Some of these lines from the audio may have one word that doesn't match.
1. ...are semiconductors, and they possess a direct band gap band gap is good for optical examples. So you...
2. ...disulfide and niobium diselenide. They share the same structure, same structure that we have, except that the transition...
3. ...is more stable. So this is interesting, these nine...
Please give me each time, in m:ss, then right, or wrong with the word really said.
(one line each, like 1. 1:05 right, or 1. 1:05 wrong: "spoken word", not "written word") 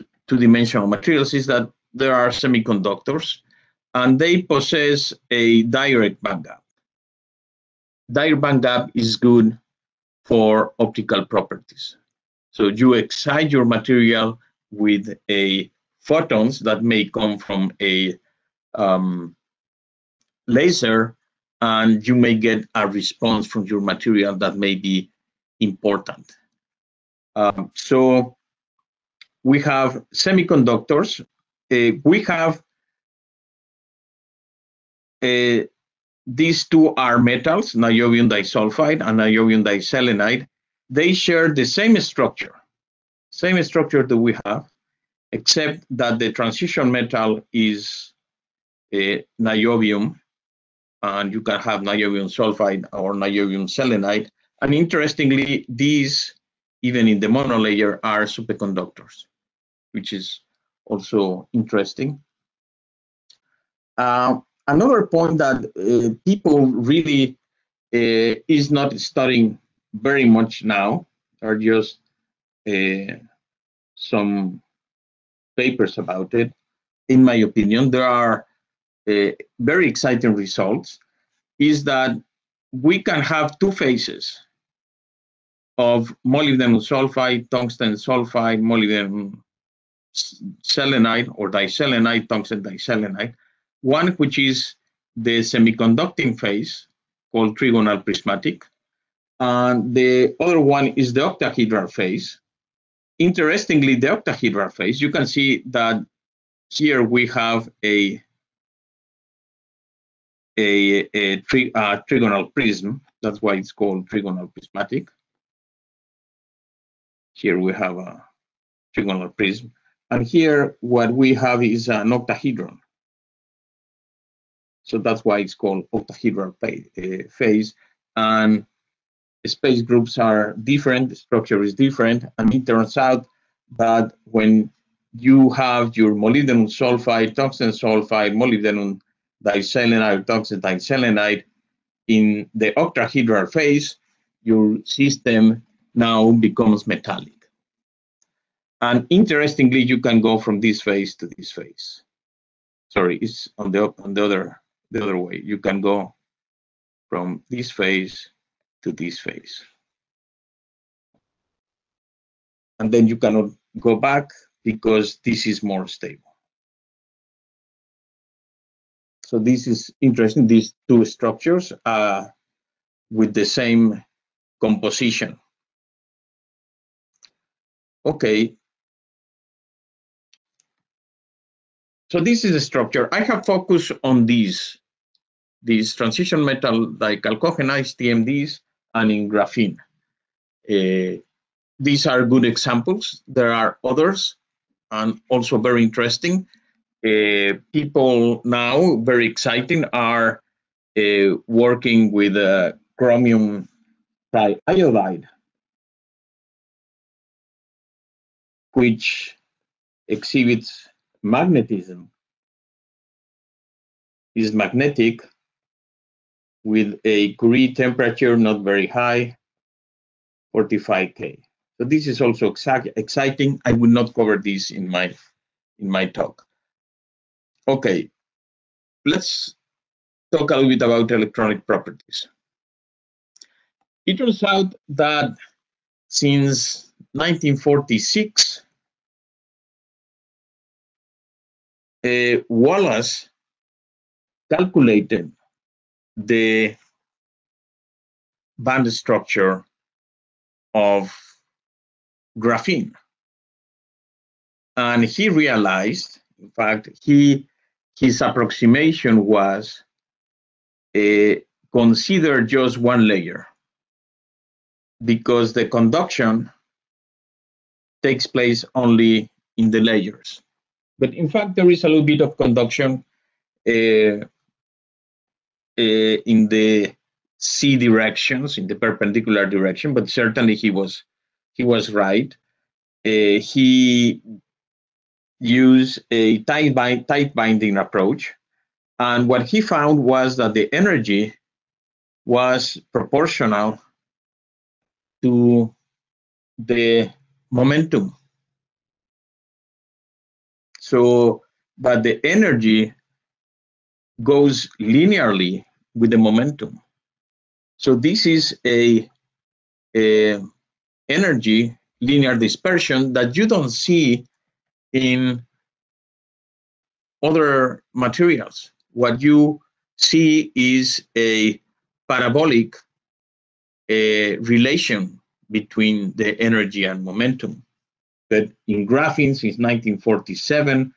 1. 0:02 wrong: "properties", not "examples"
2. 0:38 right
3. 2:45 wrong: "two", not "nine".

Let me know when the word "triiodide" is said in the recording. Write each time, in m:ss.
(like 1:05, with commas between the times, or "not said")
3:24.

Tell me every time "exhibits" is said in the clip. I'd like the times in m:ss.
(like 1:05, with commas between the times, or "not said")
3:30.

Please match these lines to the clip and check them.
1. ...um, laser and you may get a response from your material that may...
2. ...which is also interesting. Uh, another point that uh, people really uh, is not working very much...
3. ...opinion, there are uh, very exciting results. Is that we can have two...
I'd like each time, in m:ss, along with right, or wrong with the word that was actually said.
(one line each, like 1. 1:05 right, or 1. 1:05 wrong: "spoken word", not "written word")
1. 0:18 right
2. 0:59 wrong: "studying", not "working"
3. 1:17 right.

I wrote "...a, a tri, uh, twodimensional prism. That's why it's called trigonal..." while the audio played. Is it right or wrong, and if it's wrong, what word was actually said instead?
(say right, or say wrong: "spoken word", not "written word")
wrong: "trigonal", not "twodimensional".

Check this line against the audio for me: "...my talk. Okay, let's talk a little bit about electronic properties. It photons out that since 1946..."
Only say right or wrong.
wrong.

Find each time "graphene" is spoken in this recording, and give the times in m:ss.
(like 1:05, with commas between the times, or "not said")
3:09, 4:12, 5:28.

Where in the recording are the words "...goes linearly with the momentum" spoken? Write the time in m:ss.
5:04.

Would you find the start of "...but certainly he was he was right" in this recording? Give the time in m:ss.
4:39.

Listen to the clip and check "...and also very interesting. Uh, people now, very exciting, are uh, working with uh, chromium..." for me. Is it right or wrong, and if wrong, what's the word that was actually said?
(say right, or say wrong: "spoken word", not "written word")
right.